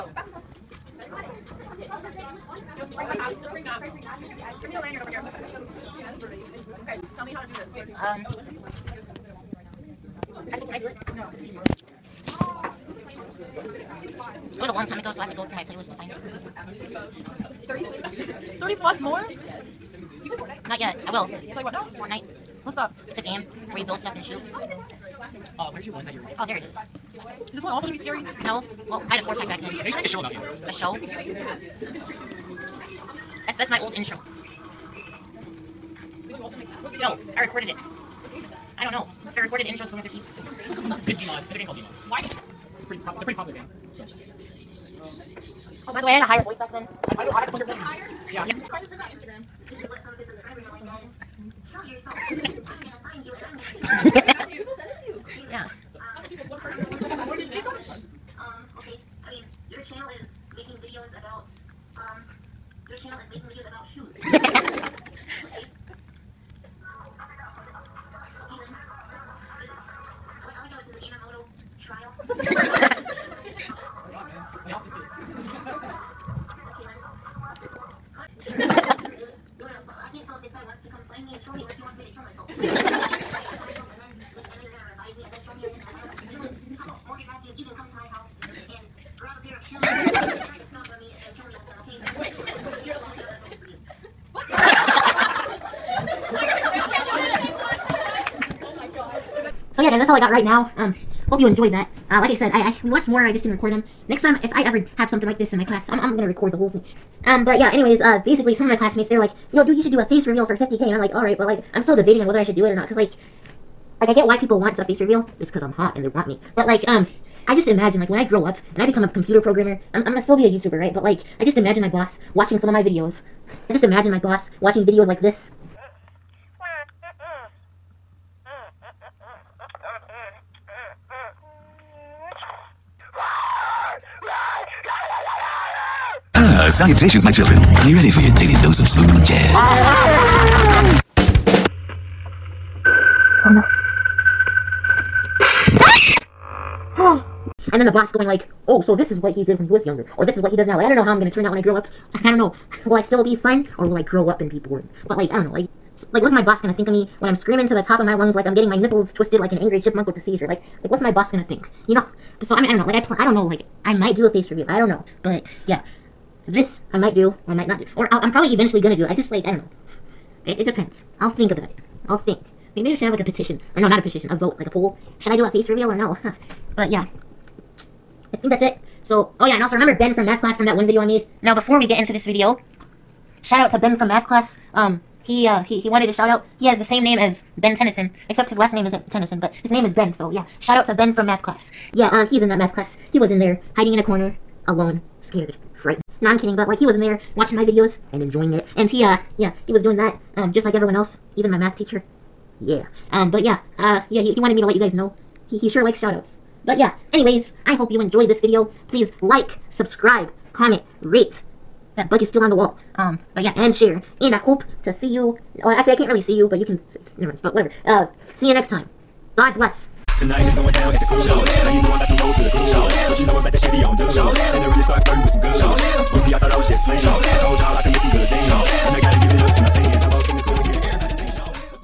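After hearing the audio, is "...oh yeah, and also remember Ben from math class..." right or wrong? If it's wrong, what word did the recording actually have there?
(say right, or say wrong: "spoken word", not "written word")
right.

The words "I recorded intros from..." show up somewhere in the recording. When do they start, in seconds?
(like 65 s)
39 s.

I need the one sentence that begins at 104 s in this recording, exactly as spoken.
Next time, if I ever have something like this in my class, I'm I'm gonna record the whole thing.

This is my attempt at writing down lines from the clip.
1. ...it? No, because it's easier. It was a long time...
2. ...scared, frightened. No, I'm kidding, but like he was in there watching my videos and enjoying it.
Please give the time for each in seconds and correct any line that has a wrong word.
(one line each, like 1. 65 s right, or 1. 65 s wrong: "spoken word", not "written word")
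1. 10 s right
2. 195 s right.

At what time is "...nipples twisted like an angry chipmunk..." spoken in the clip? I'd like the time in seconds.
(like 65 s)
158 s.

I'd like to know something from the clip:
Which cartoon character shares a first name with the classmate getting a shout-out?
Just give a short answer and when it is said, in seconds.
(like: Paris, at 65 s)
Ben Tennyson, at 187 s.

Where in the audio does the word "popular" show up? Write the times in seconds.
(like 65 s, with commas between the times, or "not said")
43 s.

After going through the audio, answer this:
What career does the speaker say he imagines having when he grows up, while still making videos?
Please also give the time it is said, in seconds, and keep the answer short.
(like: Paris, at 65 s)
Computer programmer, at 119 s.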